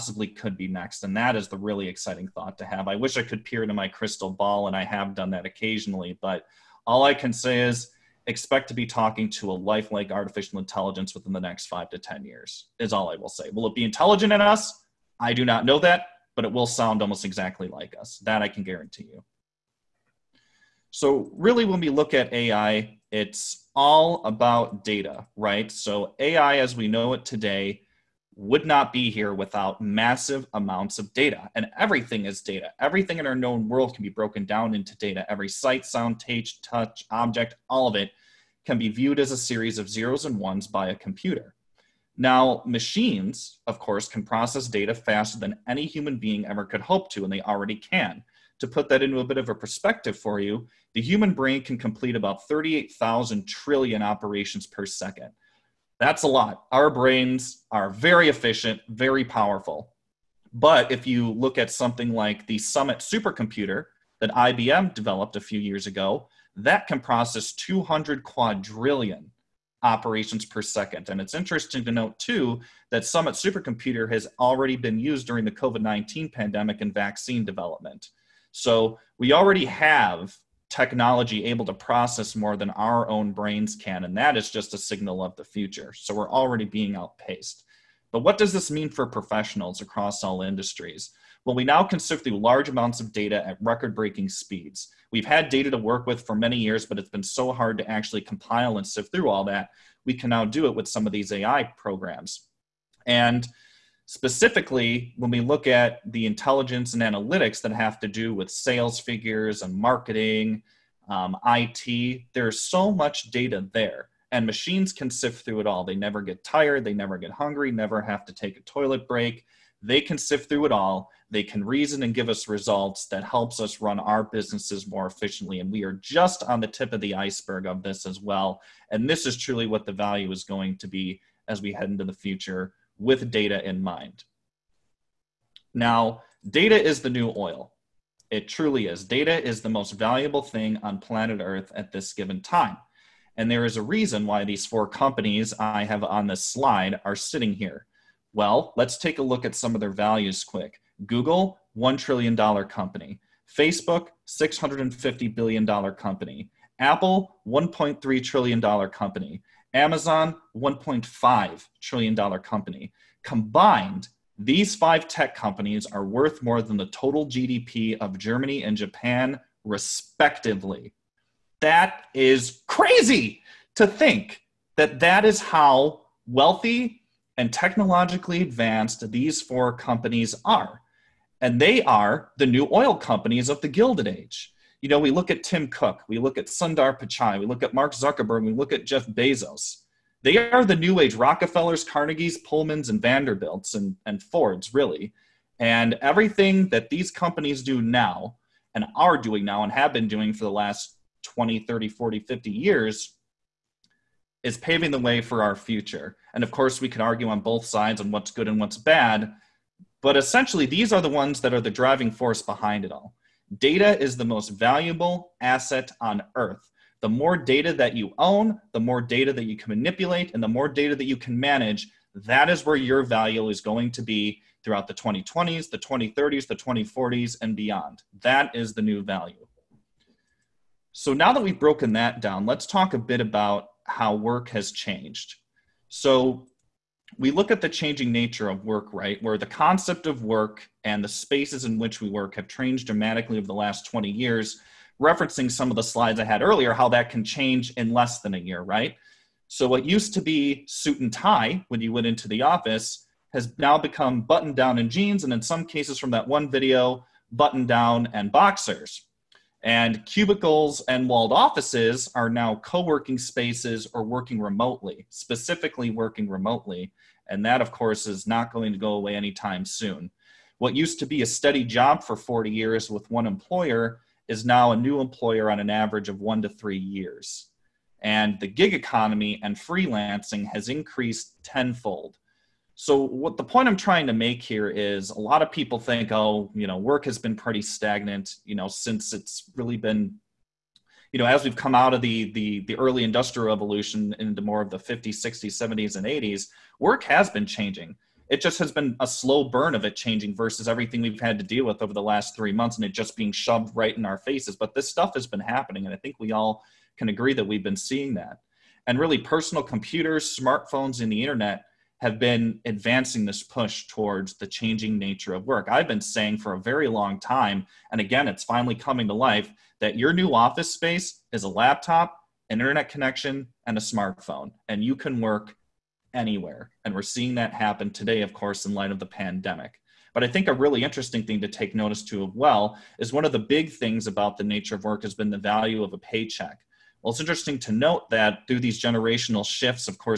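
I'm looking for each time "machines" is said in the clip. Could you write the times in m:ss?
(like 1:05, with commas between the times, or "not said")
0:42, 1:54.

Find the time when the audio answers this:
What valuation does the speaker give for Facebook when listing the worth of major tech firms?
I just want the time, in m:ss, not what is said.
2:34.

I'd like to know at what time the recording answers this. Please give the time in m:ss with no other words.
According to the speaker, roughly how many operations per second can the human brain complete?
0:52.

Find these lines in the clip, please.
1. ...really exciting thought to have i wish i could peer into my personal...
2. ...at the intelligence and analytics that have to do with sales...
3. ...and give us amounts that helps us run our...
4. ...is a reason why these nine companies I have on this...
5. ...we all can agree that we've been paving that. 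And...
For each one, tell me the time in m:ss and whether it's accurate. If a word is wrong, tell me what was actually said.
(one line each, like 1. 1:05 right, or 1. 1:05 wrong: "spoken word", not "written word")
1. 0:01 wrong: "crystal", not "personal"
2. 1:45 right
3. 2:02 wrong: "results", not "amounts"
4. 2:23 wrong: "four", not "nine"
5. 5:06 wrong: "seeing", not "paving".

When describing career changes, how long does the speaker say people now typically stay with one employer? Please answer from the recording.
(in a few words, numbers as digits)
1 to 3 years.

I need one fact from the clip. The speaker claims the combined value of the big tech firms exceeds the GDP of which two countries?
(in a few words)
Germany and Japan.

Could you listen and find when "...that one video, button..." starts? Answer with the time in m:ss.
4:16.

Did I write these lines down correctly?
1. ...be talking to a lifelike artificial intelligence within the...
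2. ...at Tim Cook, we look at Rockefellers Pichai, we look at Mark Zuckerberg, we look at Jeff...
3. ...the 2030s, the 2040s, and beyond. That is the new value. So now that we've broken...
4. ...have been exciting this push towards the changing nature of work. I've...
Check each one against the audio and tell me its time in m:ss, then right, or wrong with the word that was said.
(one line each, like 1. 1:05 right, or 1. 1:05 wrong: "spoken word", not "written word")
1. 0:08 right
2. 3:05 wrong: "Sundar", not "Rockefellers"
3. 3:45 right
4. 5:12 wrong: "advancing", not "exciting".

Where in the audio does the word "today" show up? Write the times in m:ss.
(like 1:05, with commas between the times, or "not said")
0:27, 5:27.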